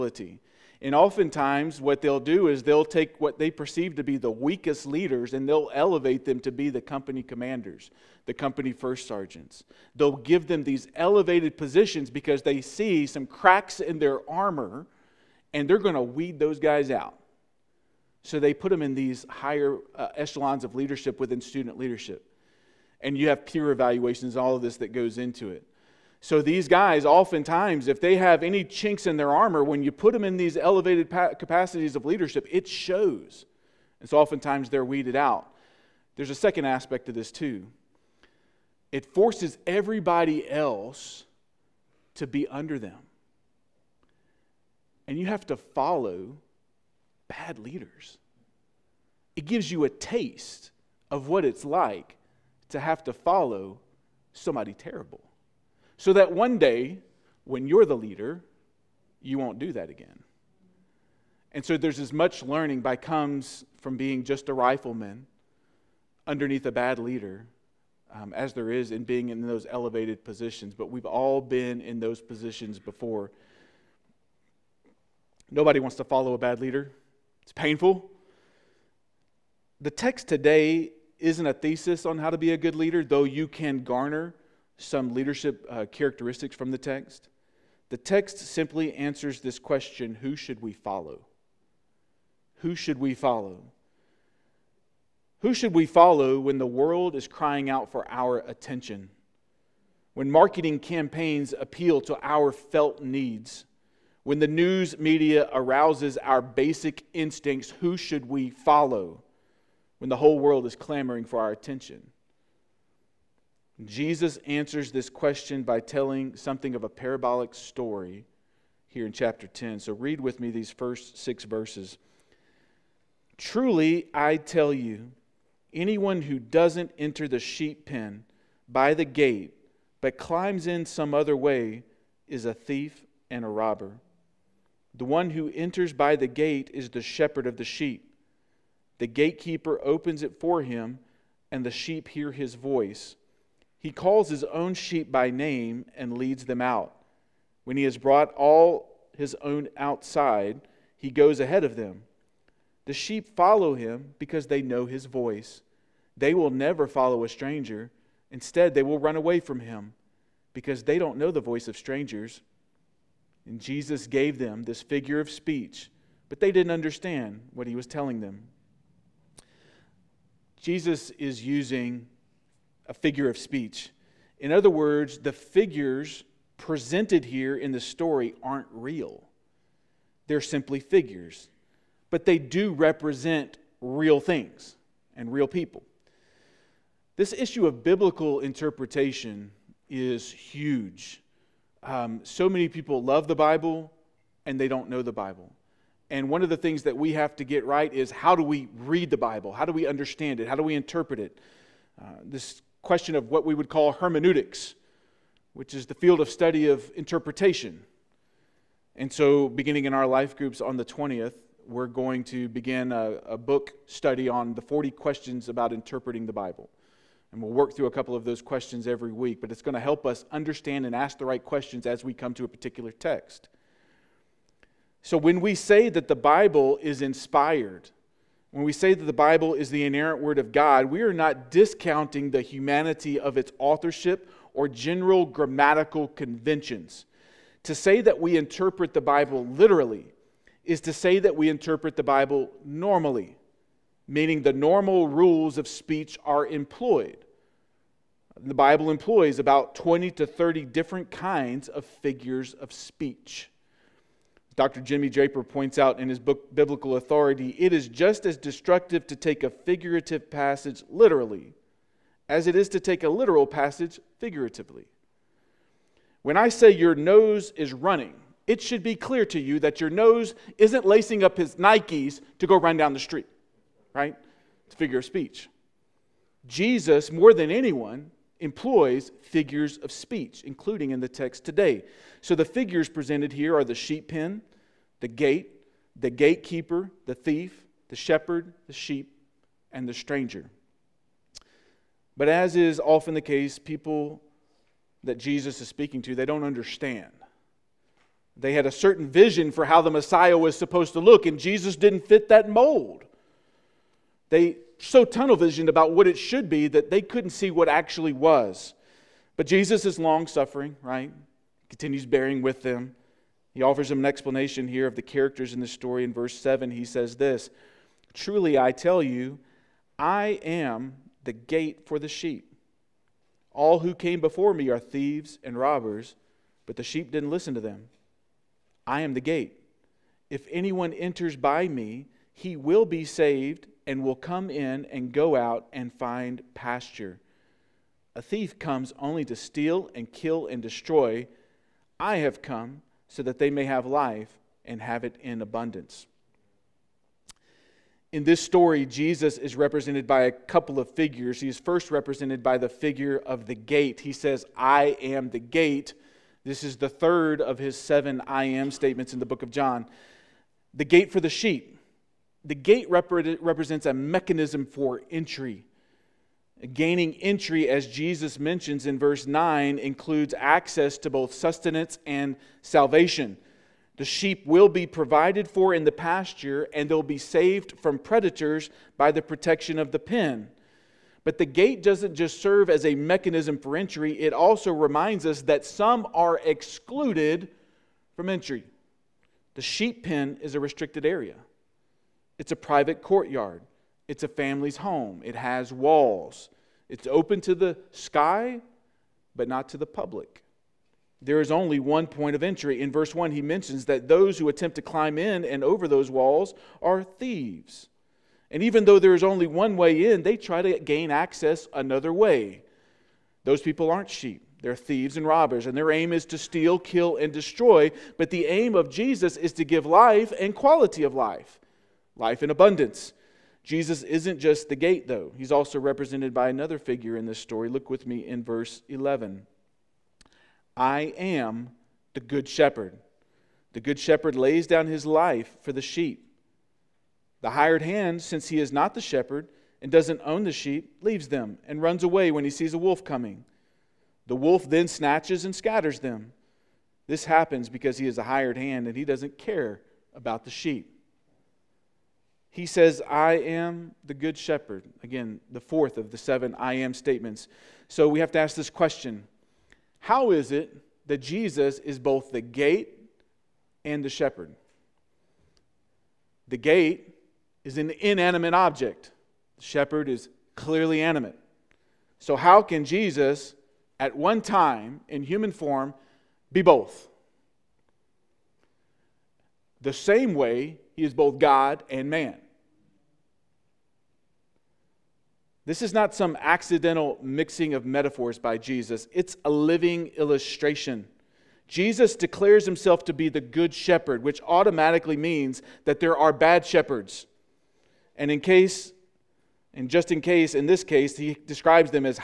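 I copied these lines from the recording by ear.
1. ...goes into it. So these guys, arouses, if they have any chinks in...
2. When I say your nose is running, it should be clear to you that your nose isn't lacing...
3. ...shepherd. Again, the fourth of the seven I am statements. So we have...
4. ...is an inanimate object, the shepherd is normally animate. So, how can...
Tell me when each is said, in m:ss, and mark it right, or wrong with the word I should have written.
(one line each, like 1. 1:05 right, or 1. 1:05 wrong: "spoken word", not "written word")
1. 0:24 wrong: "oftentimes", not "arouses"
2. 4:26 right
3. 7:34 right
4. 7:47 wrong: "clearly", not "normally".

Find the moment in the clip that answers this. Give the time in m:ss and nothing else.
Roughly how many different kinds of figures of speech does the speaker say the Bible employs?
4:09.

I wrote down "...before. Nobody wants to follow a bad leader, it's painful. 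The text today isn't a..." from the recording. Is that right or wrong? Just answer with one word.
right.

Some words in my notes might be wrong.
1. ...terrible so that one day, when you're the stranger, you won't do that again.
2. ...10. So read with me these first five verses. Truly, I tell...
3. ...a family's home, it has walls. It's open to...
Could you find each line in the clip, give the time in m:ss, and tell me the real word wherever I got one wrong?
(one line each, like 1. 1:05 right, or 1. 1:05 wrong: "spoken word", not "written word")
1. 0:54 wrong: "leader", not "stranger"
2. 1:59 wrong: "six", not "five"
3. 6:34 right.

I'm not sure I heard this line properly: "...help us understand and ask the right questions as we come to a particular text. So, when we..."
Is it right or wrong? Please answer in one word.
right.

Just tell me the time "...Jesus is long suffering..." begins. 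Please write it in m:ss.
5:09.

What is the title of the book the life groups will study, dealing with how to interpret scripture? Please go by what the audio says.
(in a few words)
40 Questions About Interpreting the Bible.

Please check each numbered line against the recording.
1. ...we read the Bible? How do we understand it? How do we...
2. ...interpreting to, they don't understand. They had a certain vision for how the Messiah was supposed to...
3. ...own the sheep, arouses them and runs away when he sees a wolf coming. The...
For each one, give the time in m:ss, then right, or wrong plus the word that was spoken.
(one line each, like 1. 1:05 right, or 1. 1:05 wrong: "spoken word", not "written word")
1. 3:18 right
2. 4:55 wrong: "speaking", not "interpreting"
3. 7:20 wrong: "leaves", not "arouses".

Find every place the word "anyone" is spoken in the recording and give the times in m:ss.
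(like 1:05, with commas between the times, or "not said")
2:05, 4:37, 5:30.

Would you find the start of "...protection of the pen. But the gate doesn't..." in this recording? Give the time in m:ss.
6:19.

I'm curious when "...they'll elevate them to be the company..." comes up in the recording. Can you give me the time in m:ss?
0:05.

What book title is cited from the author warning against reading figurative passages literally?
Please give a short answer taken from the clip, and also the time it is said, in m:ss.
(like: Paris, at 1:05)
Biblical Authority, at 4:16.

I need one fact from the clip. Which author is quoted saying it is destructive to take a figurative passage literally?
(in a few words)
Jimmy Draper.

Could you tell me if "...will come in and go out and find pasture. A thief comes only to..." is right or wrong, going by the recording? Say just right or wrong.
right.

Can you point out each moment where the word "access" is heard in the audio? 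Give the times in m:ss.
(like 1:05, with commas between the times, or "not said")
6:10, 6:51.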